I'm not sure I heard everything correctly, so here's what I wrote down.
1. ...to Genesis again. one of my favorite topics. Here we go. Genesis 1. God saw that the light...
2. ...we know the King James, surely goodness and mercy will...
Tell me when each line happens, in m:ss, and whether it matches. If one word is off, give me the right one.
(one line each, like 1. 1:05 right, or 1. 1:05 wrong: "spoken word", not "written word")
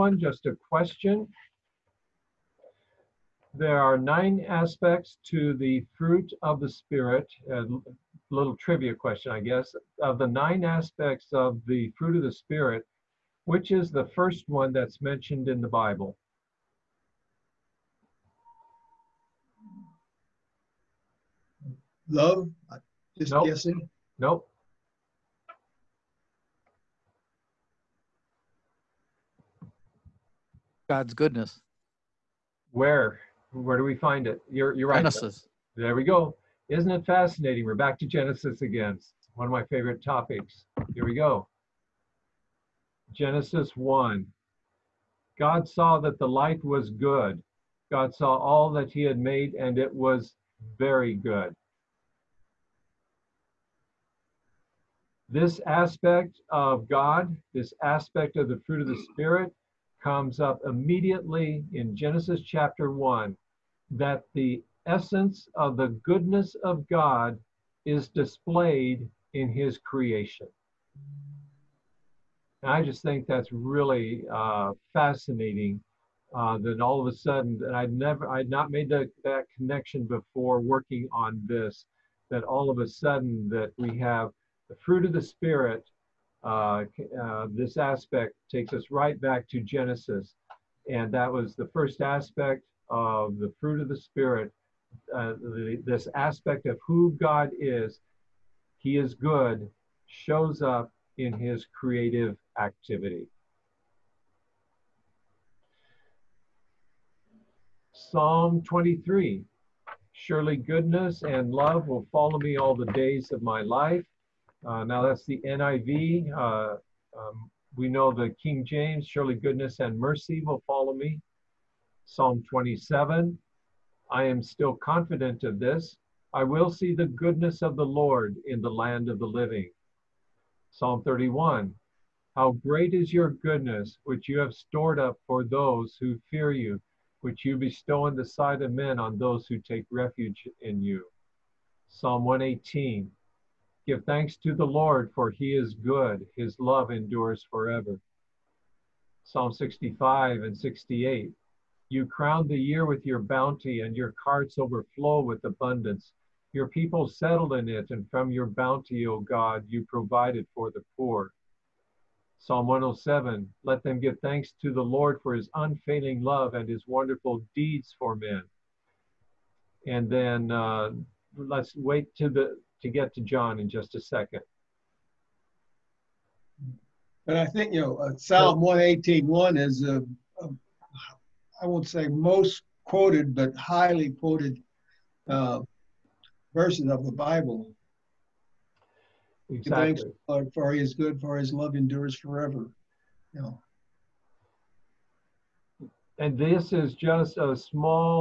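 1. 0:37 right
2. 1:57 right.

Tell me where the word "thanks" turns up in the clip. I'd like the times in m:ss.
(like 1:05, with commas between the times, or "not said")
2:24, 2:44, 3:09.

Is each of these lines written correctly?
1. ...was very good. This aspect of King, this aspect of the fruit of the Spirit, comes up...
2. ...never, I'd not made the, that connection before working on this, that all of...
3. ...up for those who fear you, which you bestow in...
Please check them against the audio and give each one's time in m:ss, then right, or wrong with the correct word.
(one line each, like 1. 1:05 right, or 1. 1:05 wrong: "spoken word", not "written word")
1. 0:49 wrong: "God", not "King"
2. 1:17 right
3. 2:14 right.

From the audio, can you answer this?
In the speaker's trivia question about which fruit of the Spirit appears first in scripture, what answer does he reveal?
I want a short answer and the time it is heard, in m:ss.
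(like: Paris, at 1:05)
God's goodness, at 0:30.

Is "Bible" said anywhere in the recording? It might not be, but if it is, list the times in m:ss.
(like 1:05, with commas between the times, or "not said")
0:15, 3:07.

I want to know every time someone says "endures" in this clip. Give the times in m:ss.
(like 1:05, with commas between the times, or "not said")
2:26, 3:11.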